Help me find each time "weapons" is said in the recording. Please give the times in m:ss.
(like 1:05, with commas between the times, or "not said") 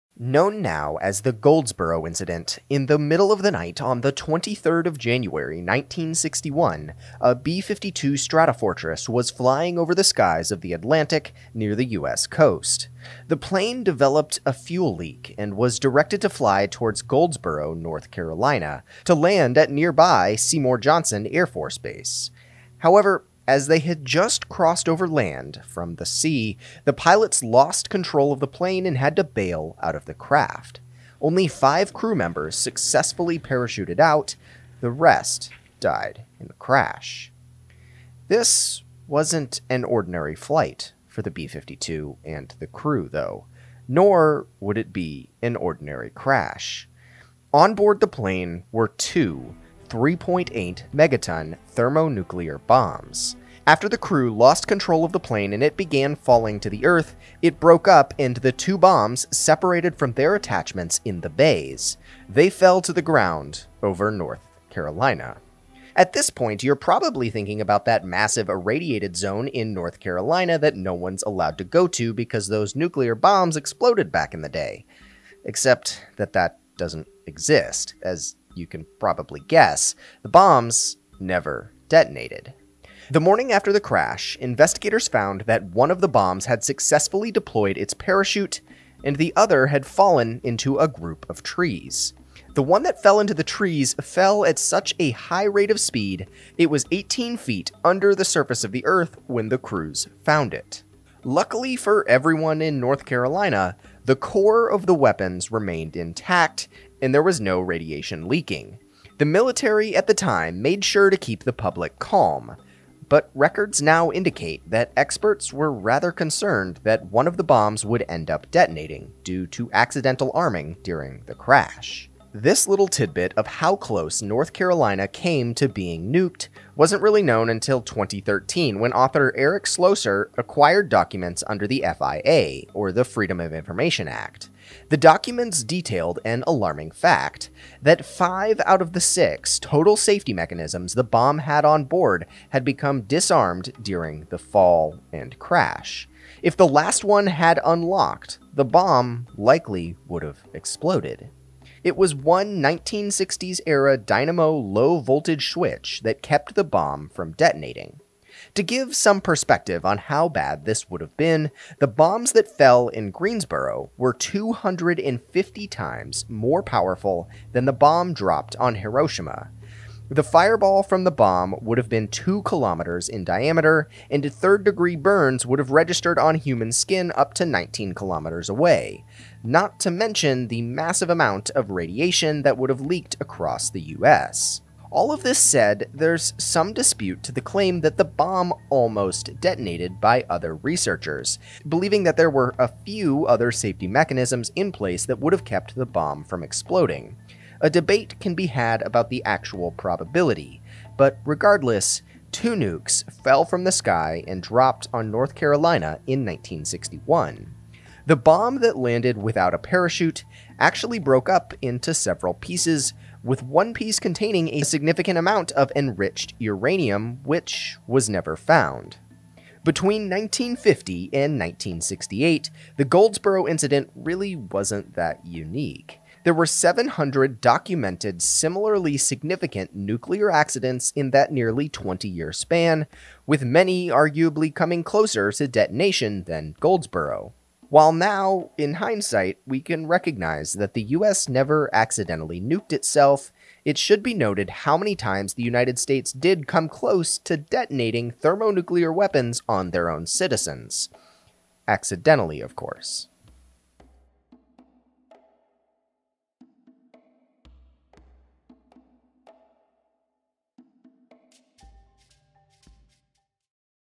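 1:44, 4:08.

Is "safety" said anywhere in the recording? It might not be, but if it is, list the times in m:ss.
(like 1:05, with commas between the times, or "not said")
2:19, 3:13.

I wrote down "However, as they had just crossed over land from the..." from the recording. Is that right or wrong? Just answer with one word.
right.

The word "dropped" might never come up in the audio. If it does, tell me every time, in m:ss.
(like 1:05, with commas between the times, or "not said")
2:48, 3:24.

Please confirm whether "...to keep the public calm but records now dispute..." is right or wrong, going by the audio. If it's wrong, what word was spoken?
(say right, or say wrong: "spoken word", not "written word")
wrong: "indicate", not "dispute".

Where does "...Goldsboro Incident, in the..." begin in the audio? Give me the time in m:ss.
0:01.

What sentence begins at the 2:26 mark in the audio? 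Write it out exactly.
If the last one had unlocked, the bomb likely would have exploded.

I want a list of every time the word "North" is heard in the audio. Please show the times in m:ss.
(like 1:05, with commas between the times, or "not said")
0:17, 1:04, 1:09, 1:42, 2:04, 3:25.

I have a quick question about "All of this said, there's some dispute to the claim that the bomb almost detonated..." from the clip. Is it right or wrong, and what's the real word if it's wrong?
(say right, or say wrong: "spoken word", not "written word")
right.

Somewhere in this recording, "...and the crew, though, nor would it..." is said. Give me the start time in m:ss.
0:42.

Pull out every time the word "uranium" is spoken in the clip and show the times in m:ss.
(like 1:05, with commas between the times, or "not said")
3:36.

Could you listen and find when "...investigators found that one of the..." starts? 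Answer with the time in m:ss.
1:24.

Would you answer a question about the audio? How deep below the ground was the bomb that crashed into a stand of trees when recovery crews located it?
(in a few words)
18 feet.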